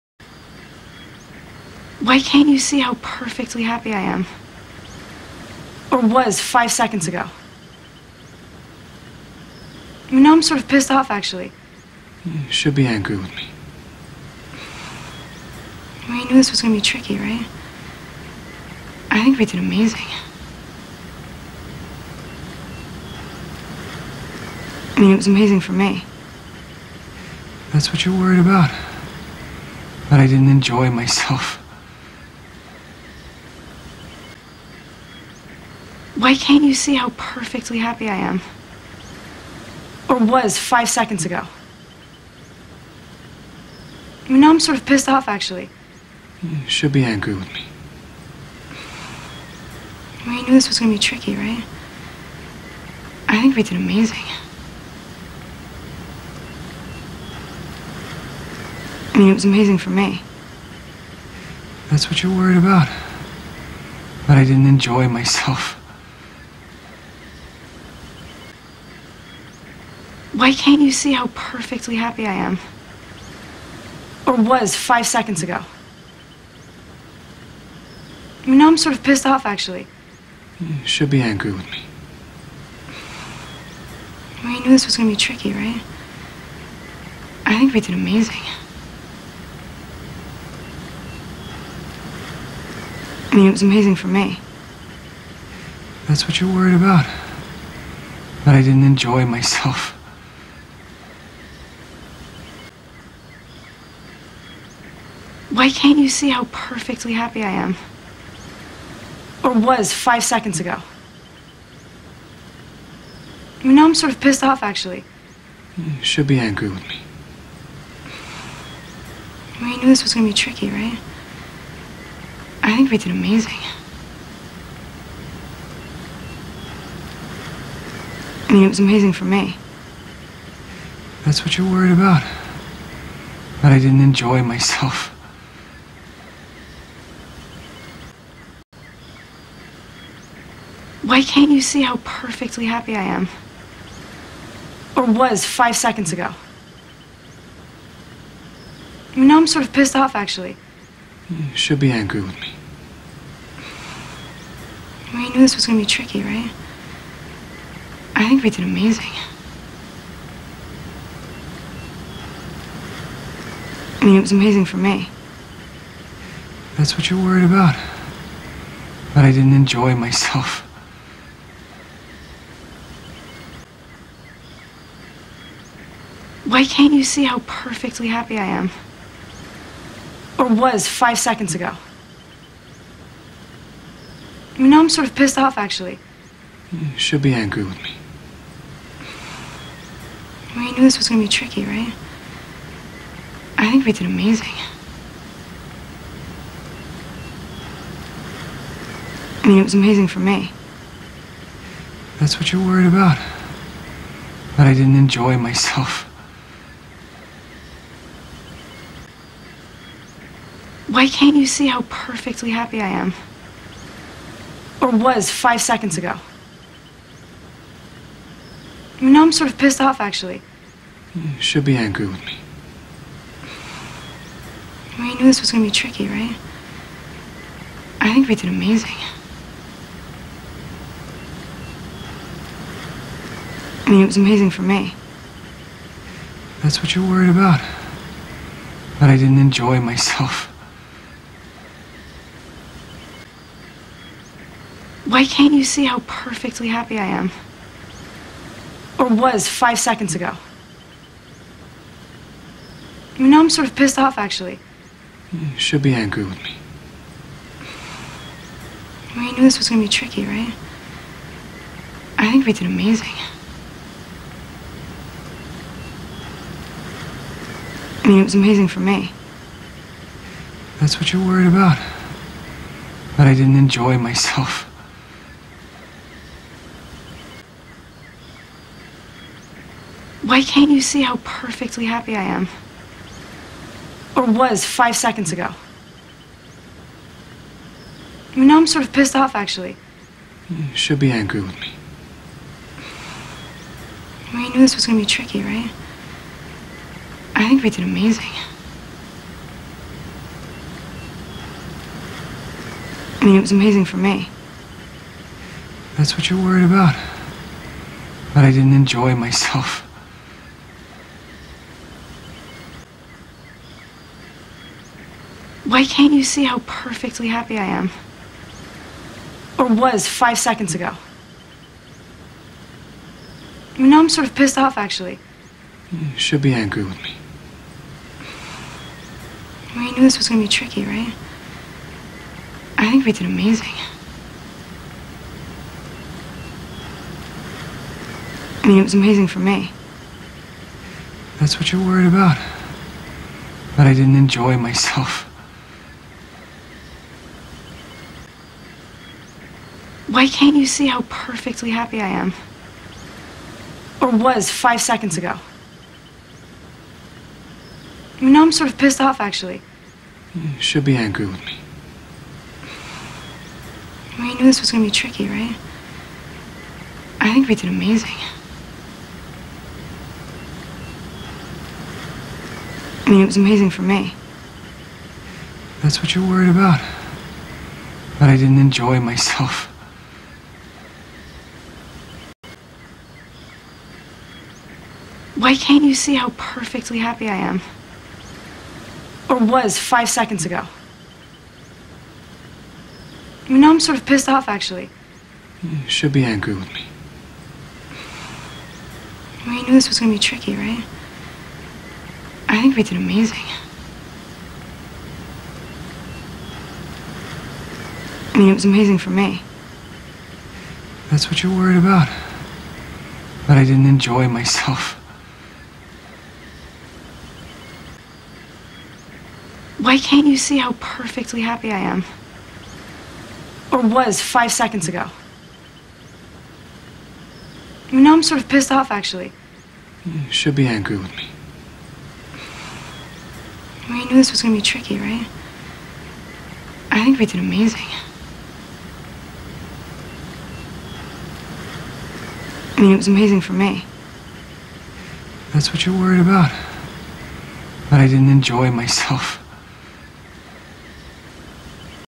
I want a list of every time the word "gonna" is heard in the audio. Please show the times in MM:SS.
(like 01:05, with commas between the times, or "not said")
04:19.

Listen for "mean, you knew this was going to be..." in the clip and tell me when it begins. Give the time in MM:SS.
04:54.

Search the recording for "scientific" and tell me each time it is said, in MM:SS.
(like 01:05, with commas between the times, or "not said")
not said.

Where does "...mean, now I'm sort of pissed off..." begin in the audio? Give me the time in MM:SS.
00:44.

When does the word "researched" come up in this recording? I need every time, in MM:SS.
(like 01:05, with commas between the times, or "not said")
not said.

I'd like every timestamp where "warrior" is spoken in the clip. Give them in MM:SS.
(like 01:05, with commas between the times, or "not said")
not said.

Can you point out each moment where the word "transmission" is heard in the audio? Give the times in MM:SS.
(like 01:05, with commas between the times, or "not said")
not said.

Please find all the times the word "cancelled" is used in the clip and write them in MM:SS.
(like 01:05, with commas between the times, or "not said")
not said.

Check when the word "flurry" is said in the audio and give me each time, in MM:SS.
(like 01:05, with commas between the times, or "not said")
not said.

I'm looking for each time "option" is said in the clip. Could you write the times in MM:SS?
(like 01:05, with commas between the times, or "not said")
not said.